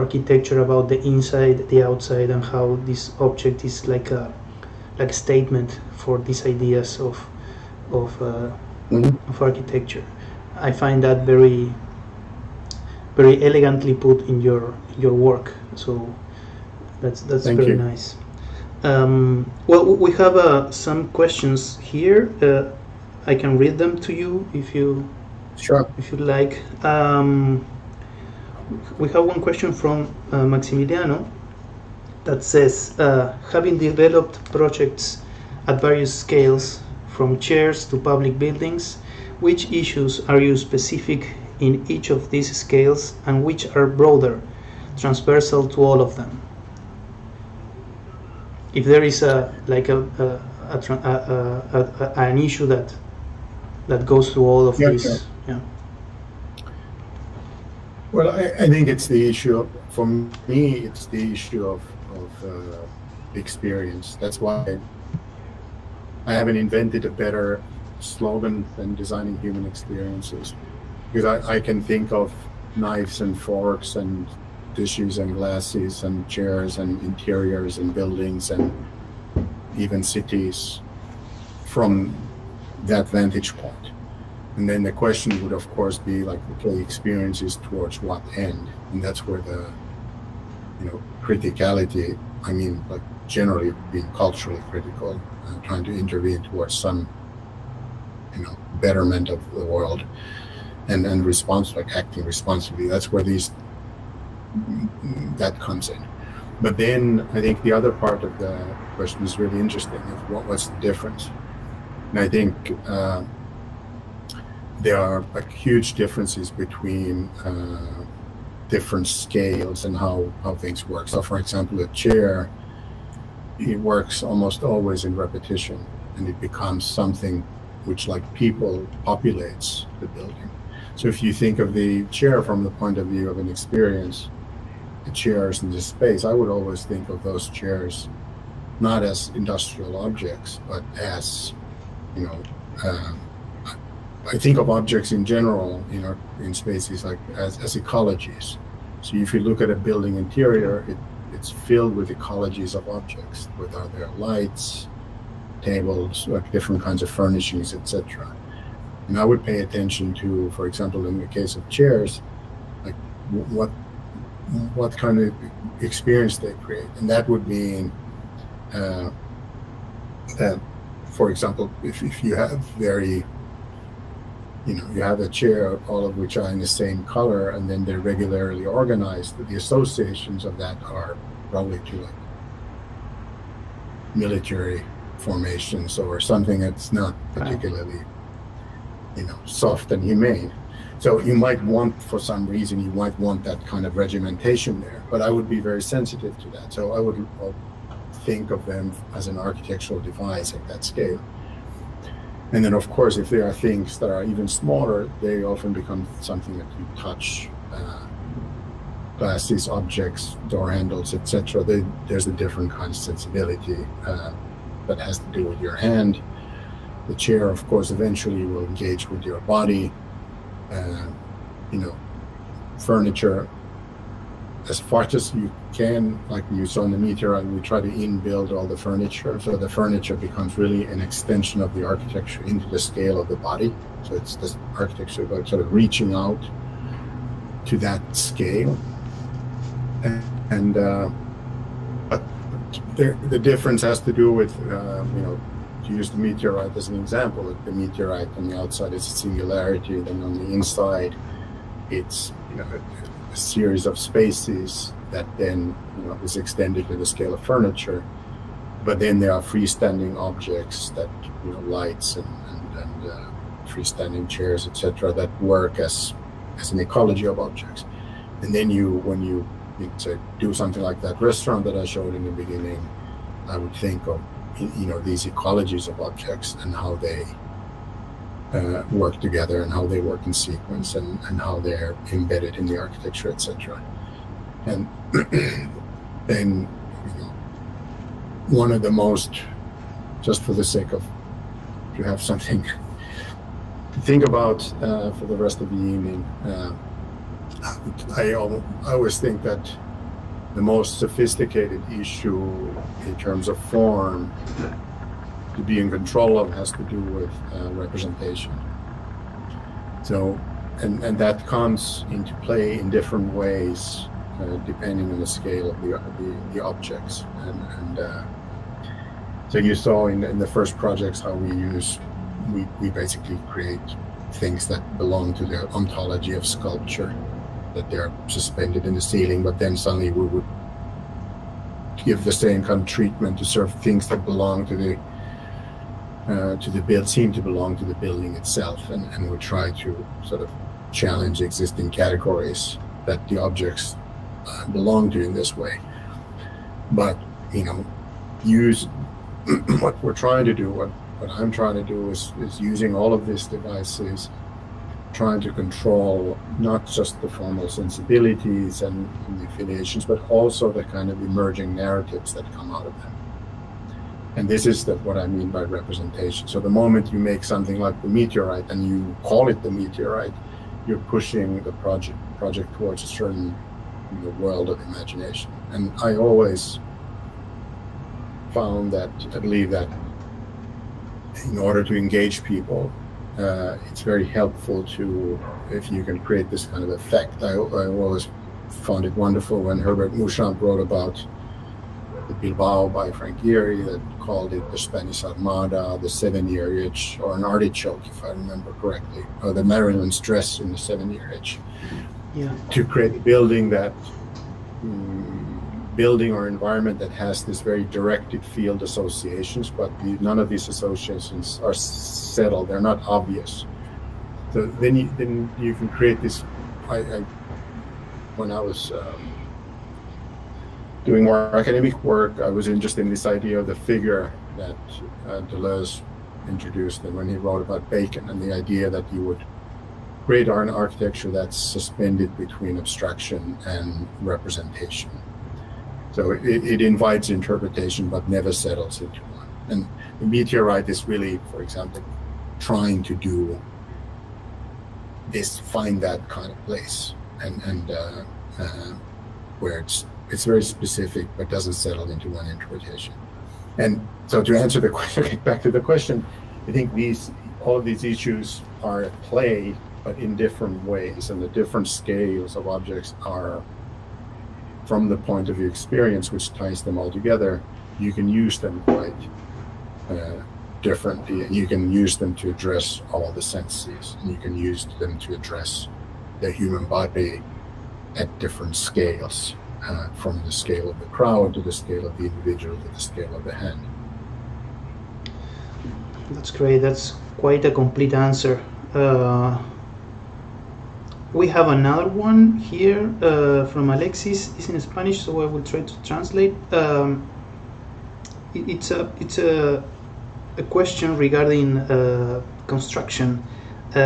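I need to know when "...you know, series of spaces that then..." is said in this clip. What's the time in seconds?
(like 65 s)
252 s.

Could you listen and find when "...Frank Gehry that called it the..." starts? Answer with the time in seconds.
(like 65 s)
393 s.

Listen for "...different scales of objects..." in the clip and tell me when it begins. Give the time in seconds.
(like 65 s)
461 s.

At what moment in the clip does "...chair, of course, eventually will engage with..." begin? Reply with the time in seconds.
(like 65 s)
217 s.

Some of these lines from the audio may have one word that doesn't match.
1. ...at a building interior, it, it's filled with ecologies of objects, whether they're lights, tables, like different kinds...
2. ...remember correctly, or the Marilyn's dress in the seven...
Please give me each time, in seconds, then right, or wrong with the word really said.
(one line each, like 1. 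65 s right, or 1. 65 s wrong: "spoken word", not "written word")
1. 149 s right
2. 398 s right.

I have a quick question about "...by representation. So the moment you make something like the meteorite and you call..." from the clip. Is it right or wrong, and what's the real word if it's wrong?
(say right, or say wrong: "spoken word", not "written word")
right.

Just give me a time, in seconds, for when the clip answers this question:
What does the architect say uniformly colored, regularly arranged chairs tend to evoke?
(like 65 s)
184 s.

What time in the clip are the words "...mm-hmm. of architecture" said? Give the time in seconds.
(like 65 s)
8 s.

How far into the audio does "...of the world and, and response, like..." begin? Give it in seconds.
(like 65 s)
99 s.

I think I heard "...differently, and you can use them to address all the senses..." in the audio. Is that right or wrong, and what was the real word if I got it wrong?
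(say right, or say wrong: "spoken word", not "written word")
right.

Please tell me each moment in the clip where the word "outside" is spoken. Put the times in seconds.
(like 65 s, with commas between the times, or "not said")
1 s, 248 s.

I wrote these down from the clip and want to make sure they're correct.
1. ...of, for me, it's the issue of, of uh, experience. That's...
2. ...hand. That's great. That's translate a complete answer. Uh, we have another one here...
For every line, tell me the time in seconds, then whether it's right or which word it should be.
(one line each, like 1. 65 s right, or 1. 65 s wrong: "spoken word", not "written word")
1. 59 s right
2. 483 s wrong: "quite", not "translate".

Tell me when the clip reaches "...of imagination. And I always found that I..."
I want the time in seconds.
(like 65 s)
374 s.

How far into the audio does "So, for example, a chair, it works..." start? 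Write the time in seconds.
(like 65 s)
121 s.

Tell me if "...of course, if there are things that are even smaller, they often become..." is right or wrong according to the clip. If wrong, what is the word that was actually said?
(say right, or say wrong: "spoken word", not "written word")
right.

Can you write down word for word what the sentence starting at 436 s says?
So it, it invites interpretation but never settles into one.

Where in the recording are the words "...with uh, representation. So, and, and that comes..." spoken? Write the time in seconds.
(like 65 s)
306 s.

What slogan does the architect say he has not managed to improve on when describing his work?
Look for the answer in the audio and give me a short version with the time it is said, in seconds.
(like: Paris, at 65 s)
designing human experiences, at 68 s.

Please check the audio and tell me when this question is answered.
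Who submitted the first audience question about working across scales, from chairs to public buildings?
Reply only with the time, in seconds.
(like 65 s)
30 s.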